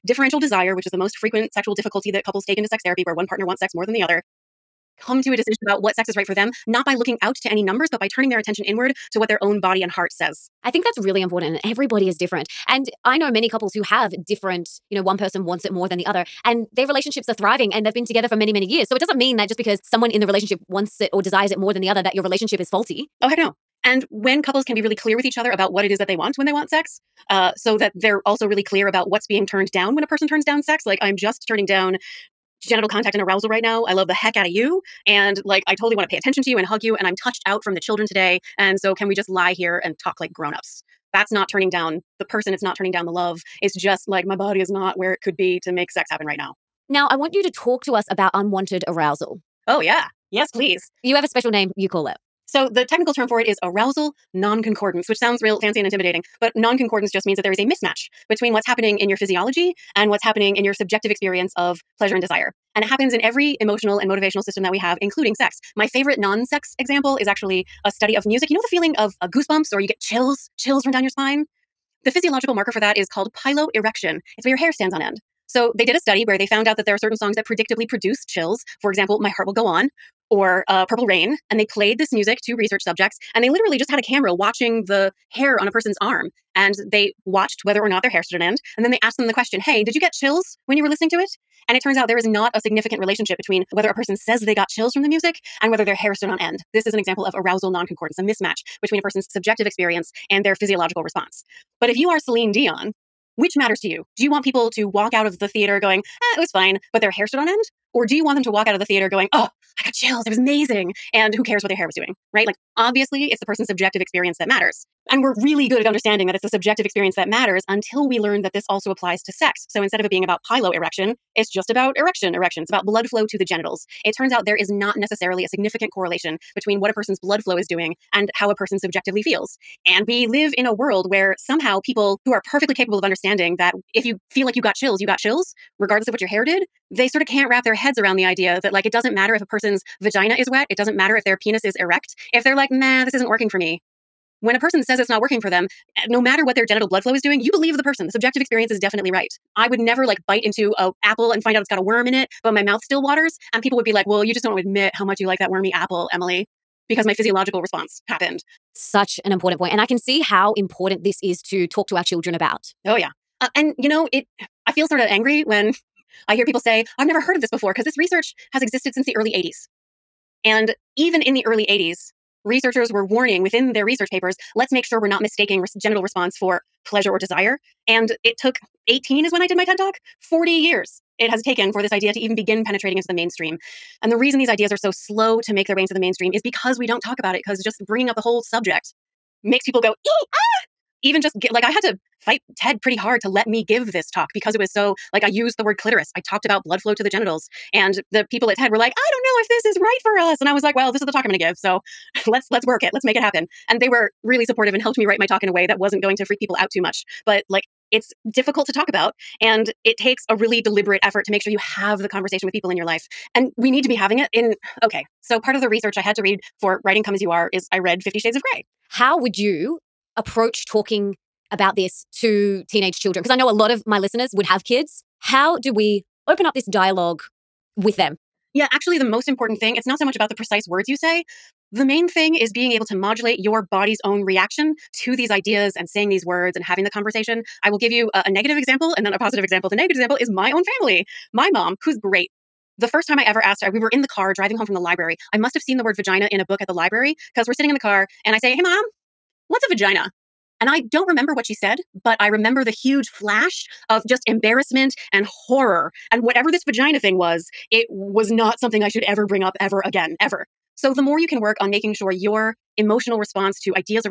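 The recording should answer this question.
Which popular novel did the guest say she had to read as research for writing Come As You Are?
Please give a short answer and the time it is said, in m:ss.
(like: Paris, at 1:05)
50 Shades of Grey, at 3:38.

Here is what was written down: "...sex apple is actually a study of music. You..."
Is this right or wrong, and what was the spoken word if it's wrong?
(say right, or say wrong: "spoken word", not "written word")
wrong: "example", not "apple".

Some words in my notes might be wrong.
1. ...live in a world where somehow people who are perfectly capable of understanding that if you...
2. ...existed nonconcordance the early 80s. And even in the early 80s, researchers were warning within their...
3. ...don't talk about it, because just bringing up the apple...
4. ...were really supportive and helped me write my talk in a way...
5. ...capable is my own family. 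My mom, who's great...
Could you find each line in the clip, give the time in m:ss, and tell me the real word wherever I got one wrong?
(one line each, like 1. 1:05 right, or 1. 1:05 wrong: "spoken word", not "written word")
1. 2:10 right
2. 2:48 wrong: "since", not "nonconcordance"
3. 3:06 wrong: "whole", not "apple"
4. 3:23 right
5. 3:59 wrong: "example", not "capable".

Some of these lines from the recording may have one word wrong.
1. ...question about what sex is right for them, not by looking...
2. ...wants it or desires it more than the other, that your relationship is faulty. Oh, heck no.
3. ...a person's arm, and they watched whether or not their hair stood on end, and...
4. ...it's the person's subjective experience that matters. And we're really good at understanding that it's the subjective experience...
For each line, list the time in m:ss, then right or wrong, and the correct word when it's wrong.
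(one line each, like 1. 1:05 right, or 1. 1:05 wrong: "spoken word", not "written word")
1. 0:05 wrong: "decision", not "question"
2. 0:20 right
3. 1:25 right
4. 1:53 right.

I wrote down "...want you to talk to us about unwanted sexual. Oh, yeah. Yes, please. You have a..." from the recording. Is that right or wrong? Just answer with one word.
wrong.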